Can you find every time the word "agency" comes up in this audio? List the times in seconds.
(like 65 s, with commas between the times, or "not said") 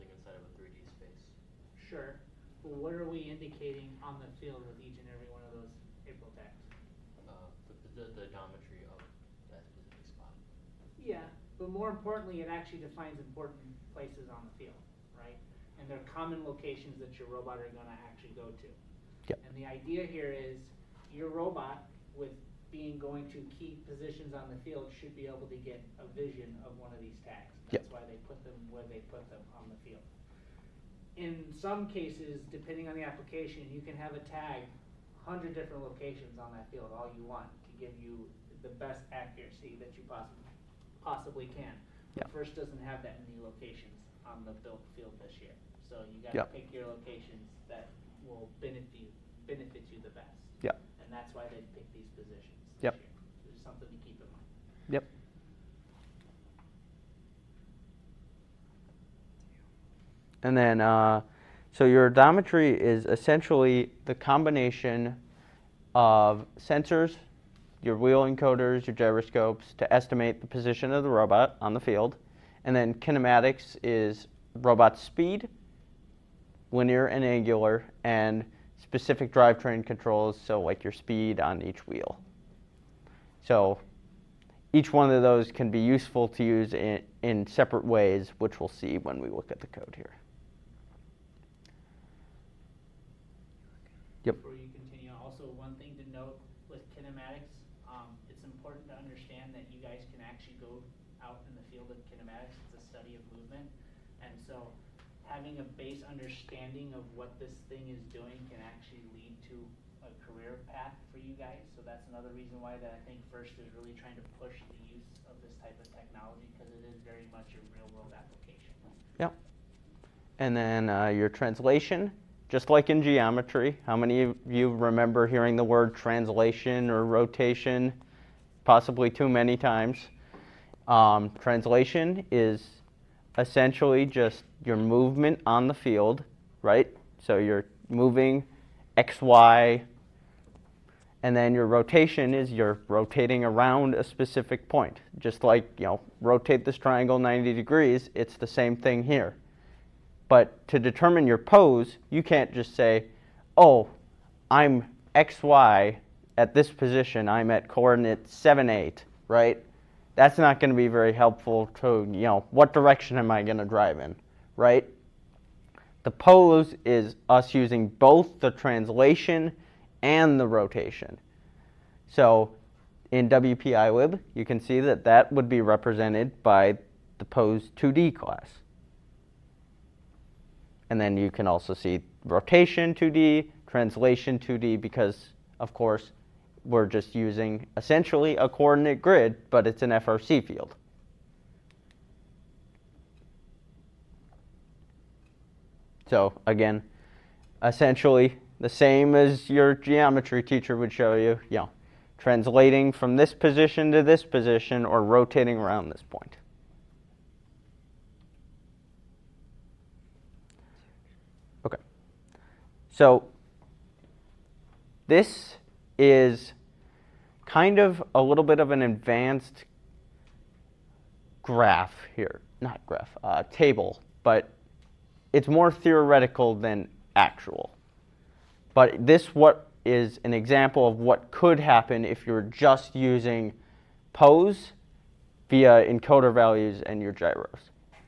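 not said.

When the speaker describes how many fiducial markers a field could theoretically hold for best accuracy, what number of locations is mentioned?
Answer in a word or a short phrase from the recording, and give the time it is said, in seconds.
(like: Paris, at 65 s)
100, at 35 s.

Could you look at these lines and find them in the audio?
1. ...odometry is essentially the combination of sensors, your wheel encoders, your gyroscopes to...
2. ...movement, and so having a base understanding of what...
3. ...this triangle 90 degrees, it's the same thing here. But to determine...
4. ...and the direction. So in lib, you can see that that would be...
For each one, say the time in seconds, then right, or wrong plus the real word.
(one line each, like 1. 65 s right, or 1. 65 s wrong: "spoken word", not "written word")
1. 62 s right
2. 103 s right
3. 146 s right
4. 170 s wrong: "rotation", not "direction".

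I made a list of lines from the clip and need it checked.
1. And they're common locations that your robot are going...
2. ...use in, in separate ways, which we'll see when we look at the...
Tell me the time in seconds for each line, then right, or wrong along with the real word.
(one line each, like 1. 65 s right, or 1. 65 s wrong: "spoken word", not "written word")
1. 15 s right
2. 86 s right.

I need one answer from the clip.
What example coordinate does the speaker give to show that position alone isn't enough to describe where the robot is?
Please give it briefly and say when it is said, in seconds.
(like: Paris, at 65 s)
7, 8, at 157 s.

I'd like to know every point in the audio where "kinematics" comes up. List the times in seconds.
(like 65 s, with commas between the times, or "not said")
72 s, 96 s, 102 s.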